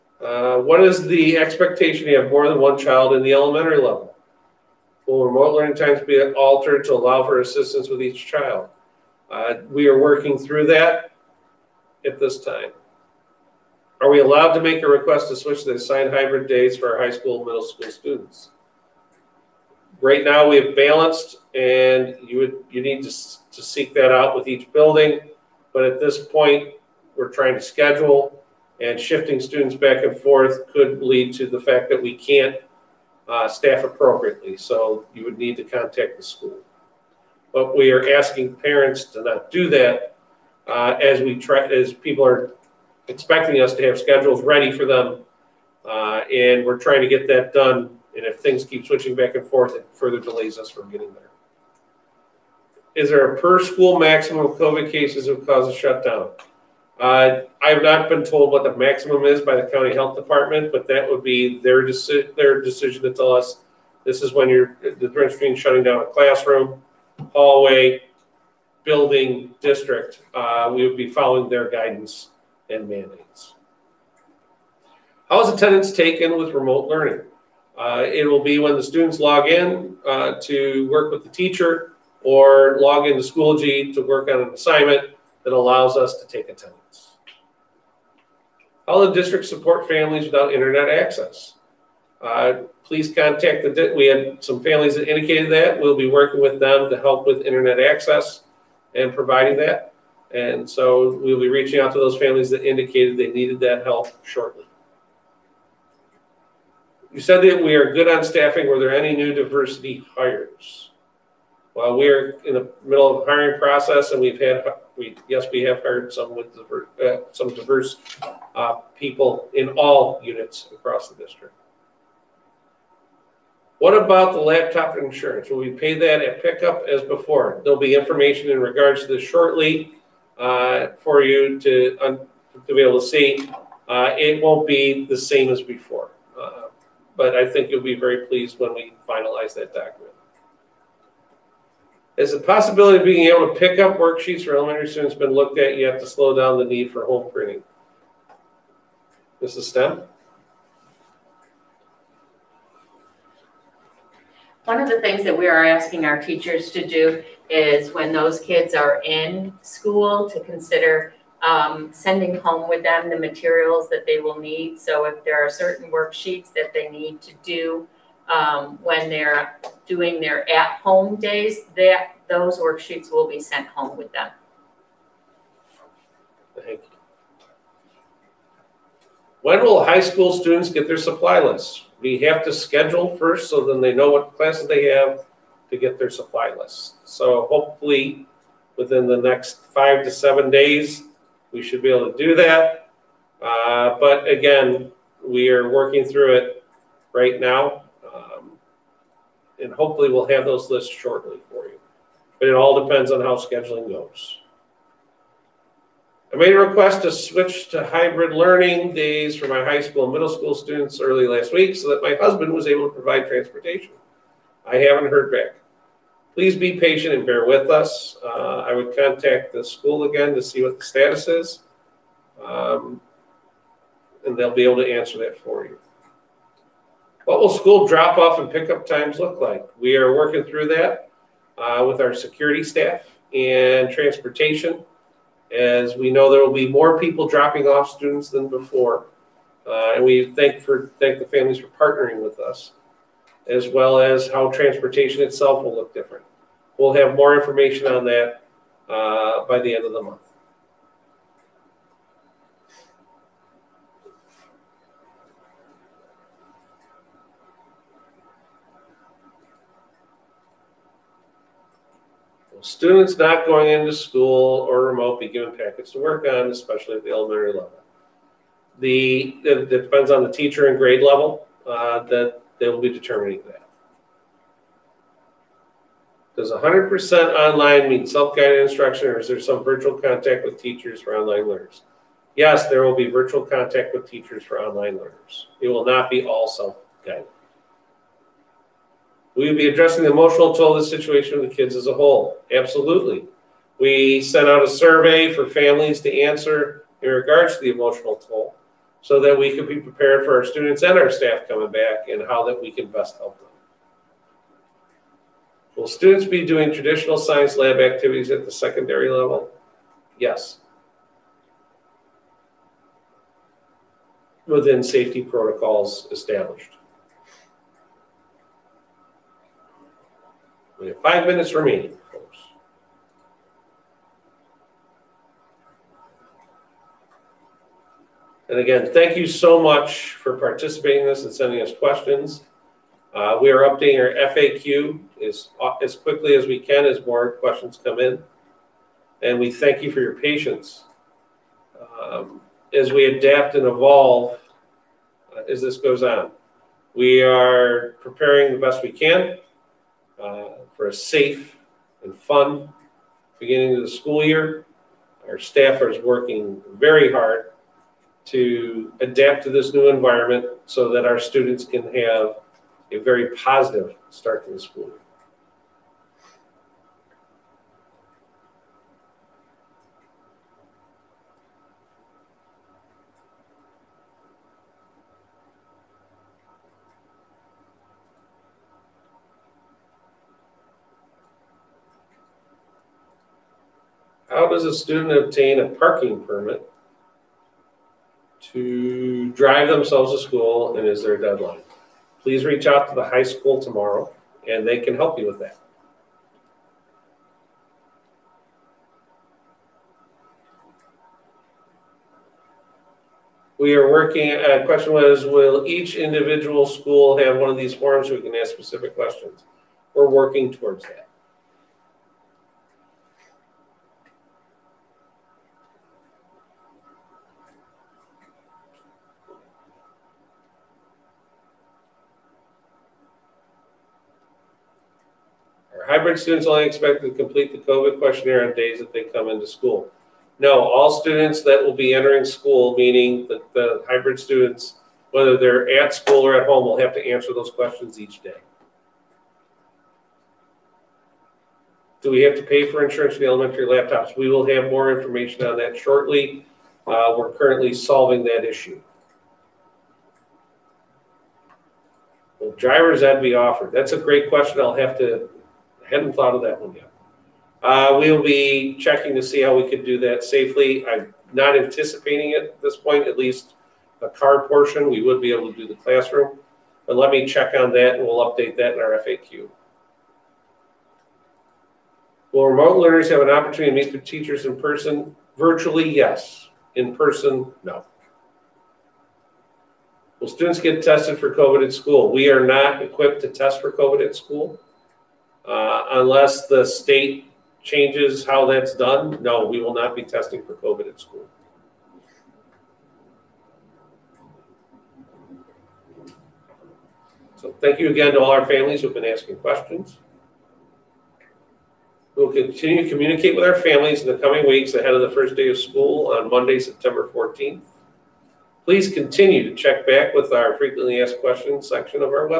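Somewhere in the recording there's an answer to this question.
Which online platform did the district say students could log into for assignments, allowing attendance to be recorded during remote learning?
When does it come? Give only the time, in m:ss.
1:23.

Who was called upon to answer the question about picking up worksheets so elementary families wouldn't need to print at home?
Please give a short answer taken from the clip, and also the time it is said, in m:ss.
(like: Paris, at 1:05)
Mrs. Stem, at 2:29.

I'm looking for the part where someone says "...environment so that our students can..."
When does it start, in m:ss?
5:59.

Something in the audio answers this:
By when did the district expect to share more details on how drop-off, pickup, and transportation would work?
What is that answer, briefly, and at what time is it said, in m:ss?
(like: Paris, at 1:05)
End of the month, at 4:09.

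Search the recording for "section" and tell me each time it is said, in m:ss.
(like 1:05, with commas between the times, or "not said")
8:31.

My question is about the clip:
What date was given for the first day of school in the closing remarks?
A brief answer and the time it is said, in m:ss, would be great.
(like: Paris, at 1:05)
Monday, September 14th, at 8:26.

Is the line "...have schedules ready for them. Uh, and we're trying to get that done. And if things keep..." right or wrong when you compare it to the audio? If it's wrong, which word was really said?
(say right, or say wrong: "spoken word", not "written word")
right.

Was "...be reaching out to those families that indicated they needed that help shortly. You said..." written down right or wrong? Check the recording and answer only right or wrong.
right.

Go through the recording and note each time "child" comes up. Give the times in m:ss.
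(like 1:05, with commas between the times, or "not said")
0:02, 0:08.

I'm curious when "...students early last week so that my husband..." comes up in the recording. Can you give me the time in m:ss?
3:30.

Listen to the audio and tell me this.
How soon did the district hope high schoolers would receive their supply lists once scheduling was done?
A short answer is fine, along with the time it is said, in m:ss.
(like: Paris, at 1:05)
5 to 7 days, at 3:09.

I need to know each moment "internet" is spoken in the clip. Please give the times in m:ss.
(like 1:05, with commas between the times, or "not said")
1:30, 1:37.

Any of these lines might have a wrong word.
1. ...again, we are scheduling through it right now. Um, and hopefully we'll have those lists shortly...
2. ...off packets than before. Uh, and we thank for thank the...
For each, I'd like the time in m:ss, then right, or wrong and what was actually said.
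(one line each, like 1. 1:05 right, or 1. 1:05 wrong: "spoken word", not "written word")
1. 3:14 wrong: "working", not "scheduling"
2. 3:57 wrong: "students", not "packets".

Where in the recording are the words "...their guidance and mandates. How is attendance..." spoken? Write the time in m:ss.
1:11.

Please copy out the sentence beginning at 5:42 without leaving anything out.
Um, as we adapt and evolve uh, as this goes on, we are preparing the best we can.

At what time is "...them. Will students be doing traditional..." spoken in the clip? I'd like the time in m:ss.
5:03.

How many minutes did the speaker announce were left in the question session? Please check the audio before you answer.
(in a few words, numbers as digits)
5.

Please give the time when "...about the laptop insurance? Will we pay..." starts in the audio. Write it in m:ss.
2:03.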